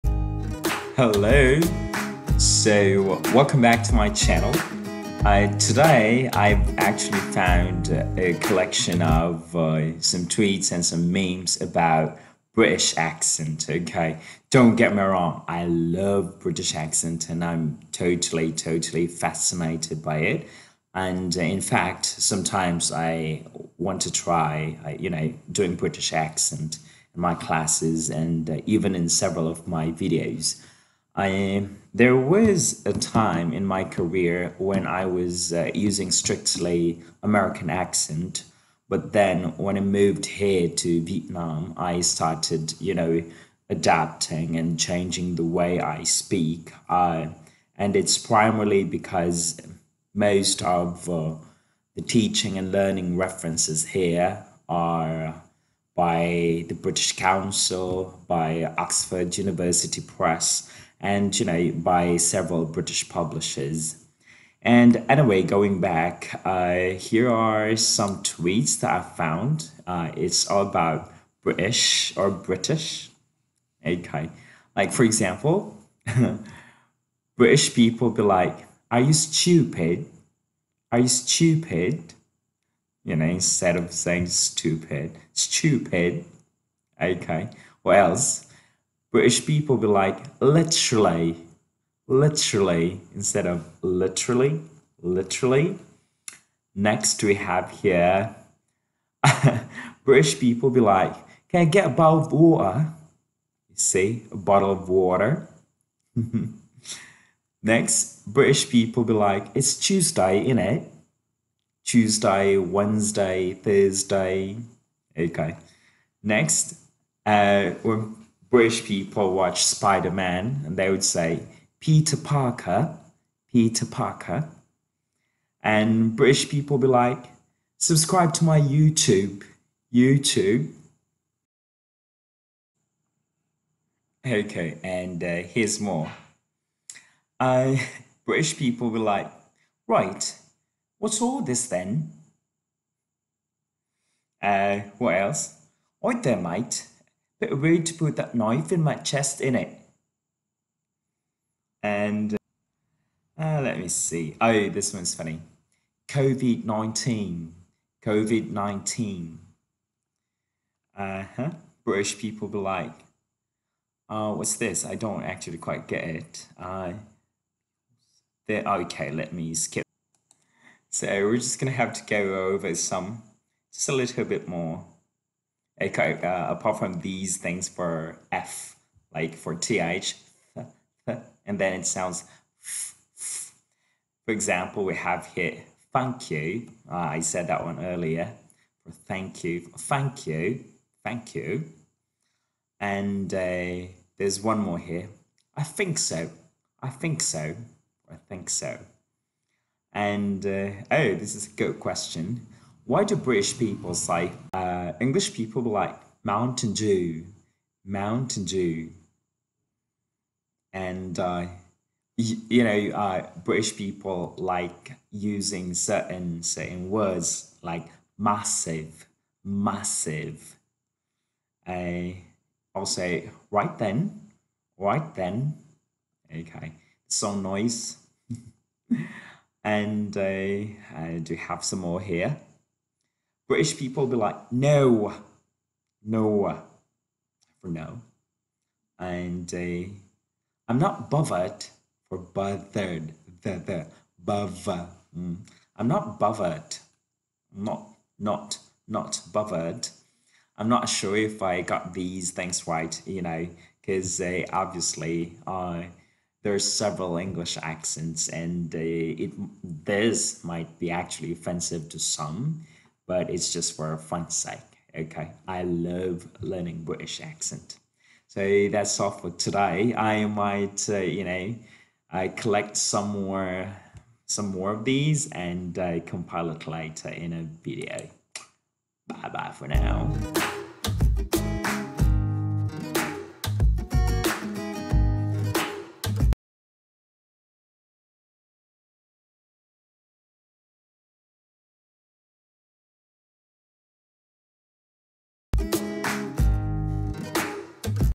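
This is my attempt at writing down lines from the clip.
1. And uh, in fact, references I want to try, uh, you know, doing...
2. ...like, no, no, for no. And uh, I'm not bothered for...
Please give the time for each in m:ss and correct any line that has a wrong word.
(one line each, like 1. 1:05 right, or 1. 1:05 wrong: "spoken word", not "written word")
1. 0:20 wrong: "sometimes", not "references"
2. 3:54 right.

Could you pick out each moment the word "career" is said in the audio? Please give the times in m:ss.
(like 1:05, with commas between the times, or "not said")
0:33.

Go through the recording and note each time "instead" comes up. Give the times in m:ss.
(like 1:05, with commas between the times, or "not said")
1:23, 1:33.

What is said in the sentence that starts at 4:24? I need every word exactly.
Okay, I love learning British accent.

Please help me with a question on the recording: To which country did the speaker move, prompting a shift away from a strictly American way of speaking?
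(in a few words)
Vietnam.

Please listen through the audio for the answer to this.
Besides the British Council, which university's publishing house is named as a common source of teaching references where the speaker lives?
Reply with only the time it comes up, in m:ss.
0:58.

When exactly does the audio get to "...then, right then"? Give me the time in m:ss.
3:43.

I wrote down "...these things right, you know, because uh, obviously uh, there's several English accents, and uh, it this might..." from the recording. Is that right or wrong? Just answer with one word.
right.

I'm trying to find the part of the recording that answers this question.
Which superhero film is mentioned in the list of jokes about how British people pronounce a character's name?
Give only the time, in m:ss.
1:59.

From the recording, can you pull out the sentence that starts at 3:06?
Uh, I said that one earlier for thank you, thank you, thank you.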